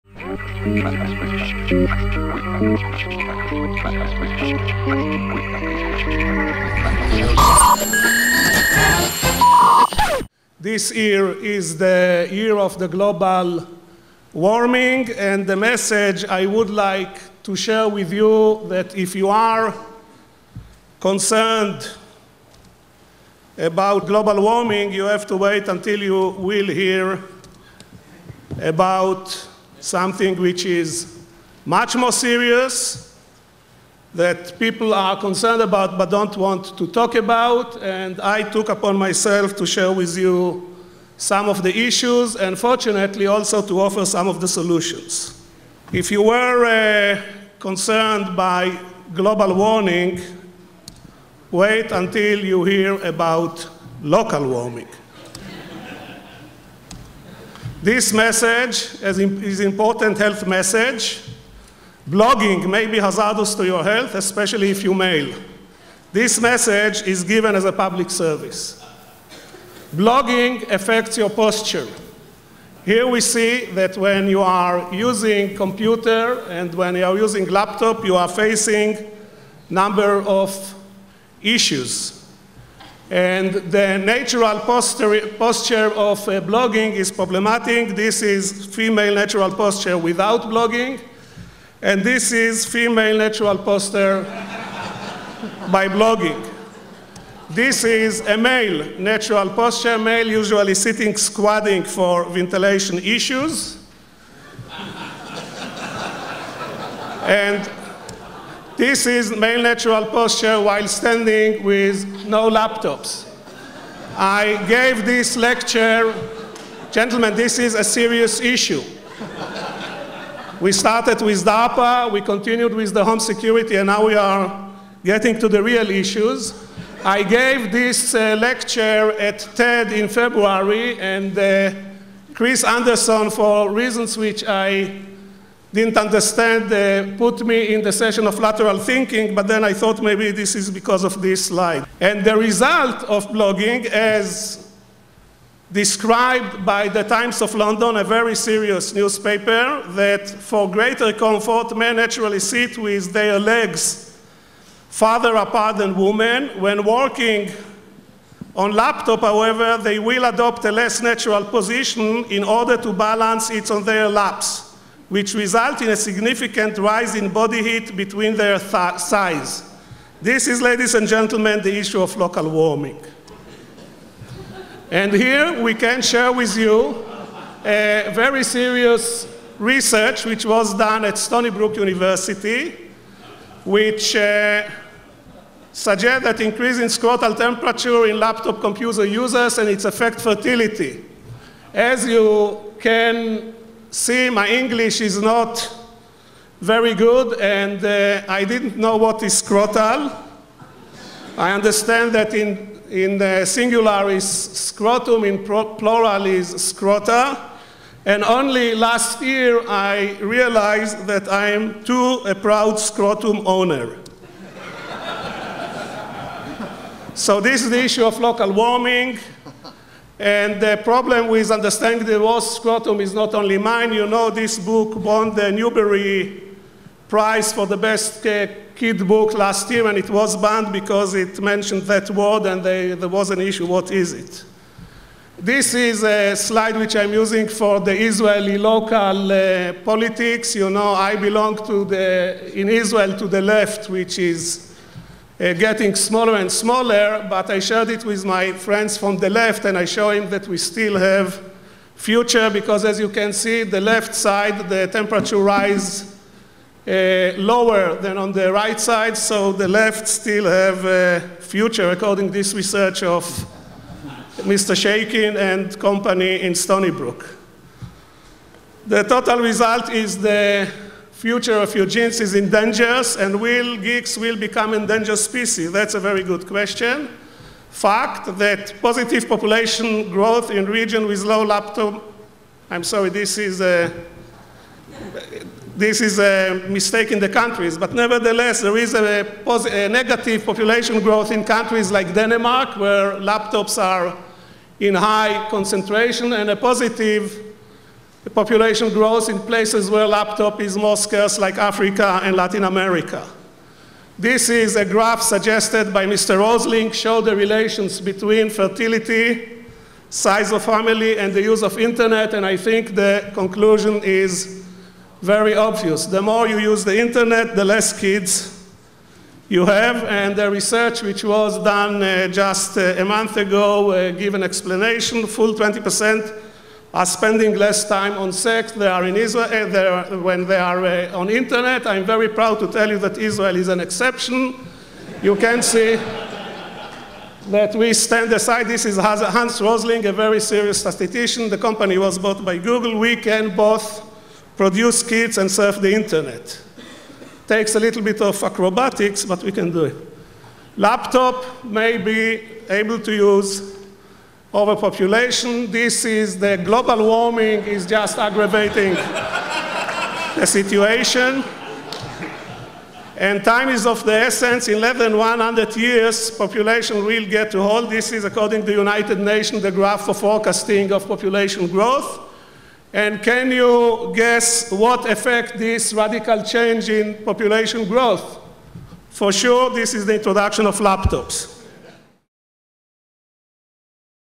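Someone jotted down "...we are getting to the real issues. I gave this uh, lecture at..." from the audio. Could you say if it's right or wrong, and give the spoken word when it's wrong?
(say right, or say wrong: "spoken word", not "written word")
right.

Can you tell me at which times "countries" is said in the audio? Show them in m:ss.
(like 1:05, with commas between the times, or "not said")
4:47, 4:51.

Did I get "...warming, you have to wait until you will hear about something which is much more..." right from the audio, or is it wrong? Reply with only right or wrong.
right.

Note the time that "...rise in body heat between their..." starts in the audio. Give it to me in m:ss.
2:46.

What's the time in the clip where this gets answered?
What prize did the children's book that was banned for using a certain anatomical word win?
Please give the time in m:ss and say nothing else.
3:45.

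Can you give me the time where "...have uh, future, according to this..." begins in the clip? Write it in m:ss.
4:20.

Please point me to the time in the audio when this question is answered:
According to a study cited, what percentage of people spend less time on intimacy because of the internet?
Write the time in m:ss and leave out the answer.
5:25.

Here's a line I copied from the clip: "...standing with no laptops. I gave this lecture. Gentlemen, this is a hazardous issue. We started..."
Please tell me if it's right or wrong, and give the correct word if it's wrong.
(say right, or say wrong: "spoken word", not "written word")
wrong: "serious", not "hazardous".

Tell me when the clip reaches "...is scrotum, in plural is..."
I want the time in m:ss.
3:24.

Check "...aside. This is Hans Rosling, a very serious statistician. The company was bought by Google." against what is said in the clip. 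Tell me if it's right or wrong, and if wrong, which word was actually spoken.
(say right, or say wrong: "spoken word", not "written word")
right.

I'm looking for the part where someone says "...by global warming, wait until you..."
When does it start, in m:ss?
0:48.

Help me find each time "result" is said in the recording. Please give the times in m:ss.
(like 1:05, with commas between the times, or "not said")
2:22, 2:45, 4:29.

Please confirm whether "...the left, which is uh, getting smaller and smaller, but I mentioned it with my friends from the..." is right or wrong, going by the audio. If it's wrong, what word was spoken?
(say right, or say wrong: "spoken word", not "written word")
wrong: "shared", not "mentioned".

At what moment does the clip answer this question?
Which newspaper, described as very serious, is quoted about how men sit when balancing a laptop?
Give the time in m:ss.
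2:27.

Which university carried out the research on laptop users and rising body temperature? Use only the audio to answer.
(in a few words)
Stony Brook University.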